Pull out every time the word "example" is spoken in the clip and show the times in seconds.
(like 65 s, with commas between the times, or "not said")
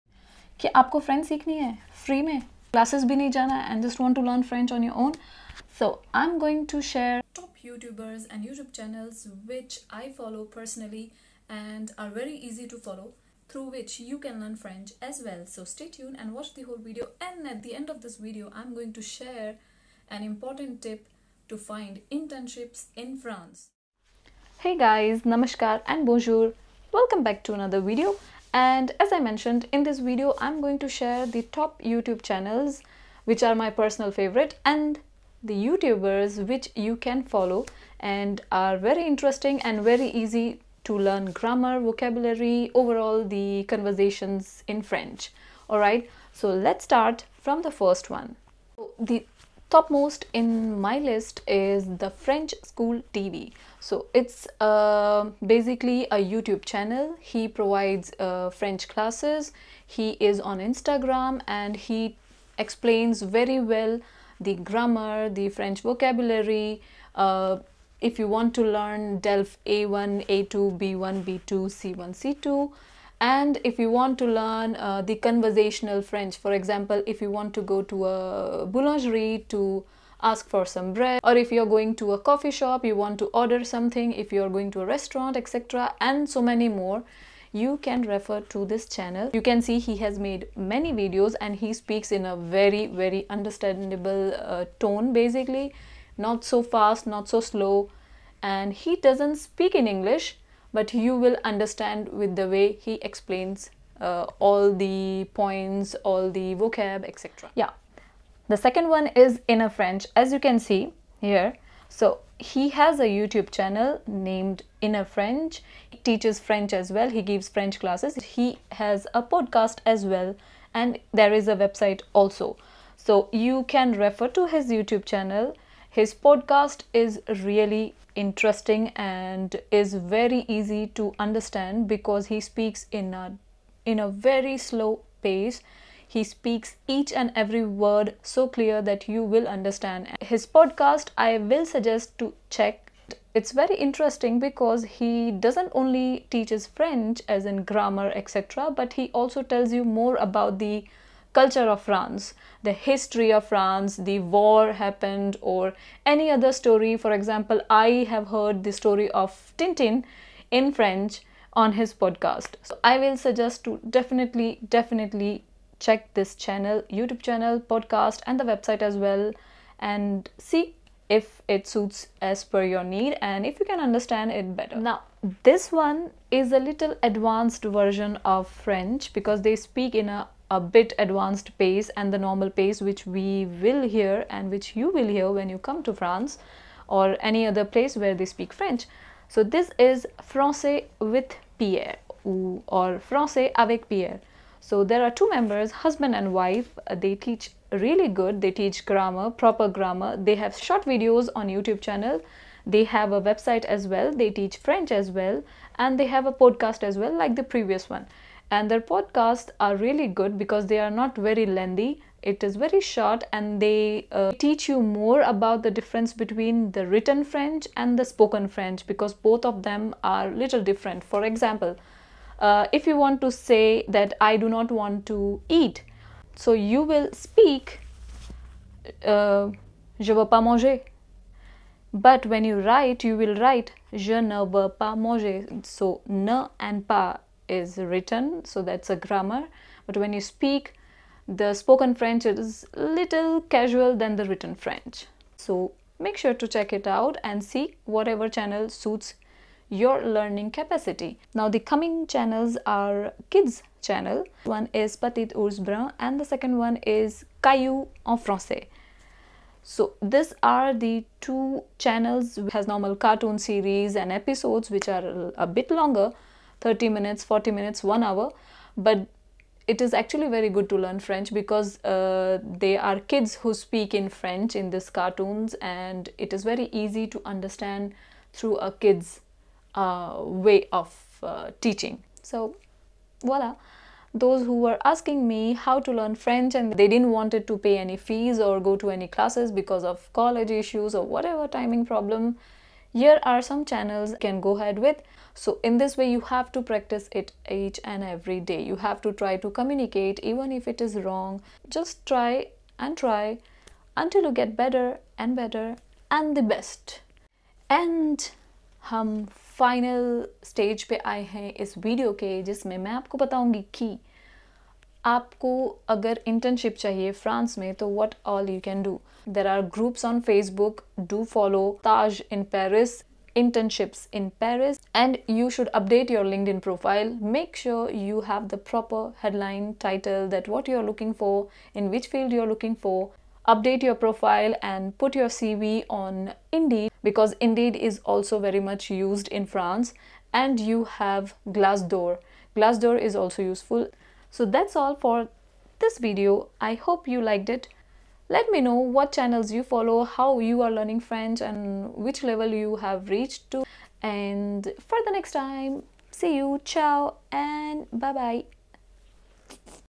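76 s, 157 s, 221 s.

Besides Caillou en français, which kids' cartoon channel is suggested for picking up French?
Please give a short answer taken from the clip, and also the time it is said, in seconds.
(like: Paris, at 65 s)
Petit Ours Brun, at 254 s.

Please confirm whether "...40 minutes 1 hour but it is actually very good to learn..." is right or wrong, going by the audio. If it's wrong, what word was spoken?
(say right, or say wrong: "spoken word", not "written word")
right.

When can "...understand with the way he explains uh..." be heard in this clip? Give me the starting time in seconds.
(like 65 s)
101 s.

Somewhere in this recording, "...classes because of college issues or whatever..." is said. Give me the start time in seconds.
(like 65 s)
289 s.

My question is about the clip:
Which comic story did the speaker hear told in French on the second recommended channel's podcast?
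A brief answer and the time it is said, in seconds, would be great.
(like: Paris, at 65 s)
Tintin, at 159 s.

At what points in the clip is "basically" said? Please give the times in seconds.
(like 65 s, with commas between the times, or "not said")
55 s, 95 s.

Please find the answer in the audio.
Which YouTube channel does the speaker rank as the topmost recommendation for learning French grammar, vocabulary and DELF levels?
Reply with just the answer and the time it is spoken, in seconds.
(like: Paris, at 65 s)
French School TV, at 52 s.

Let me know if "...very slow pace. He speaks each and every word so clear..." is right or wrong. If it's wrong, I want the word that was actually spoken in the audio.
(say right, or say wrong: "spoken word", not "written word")
right.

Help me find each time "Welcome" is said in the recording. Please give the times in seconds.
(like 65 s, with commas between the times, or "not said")
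26 s.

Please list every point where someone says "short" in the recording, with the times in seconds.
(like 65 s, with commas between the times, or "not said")
200 s, 212 s.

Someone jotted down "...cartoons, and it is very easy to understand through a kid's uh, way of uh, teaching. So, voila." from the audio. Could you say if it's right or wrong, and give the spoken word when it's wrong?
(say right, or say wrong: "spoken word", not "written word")
right.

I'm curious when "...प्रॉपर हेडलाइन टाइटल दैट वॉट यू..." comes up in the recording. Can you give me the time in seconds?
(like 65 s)
328 s.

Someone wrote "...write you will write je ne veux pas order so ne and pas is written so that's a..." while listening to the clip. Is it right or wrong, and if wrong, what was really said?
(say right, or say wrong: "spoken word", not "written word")
wrong: "manger", not "order".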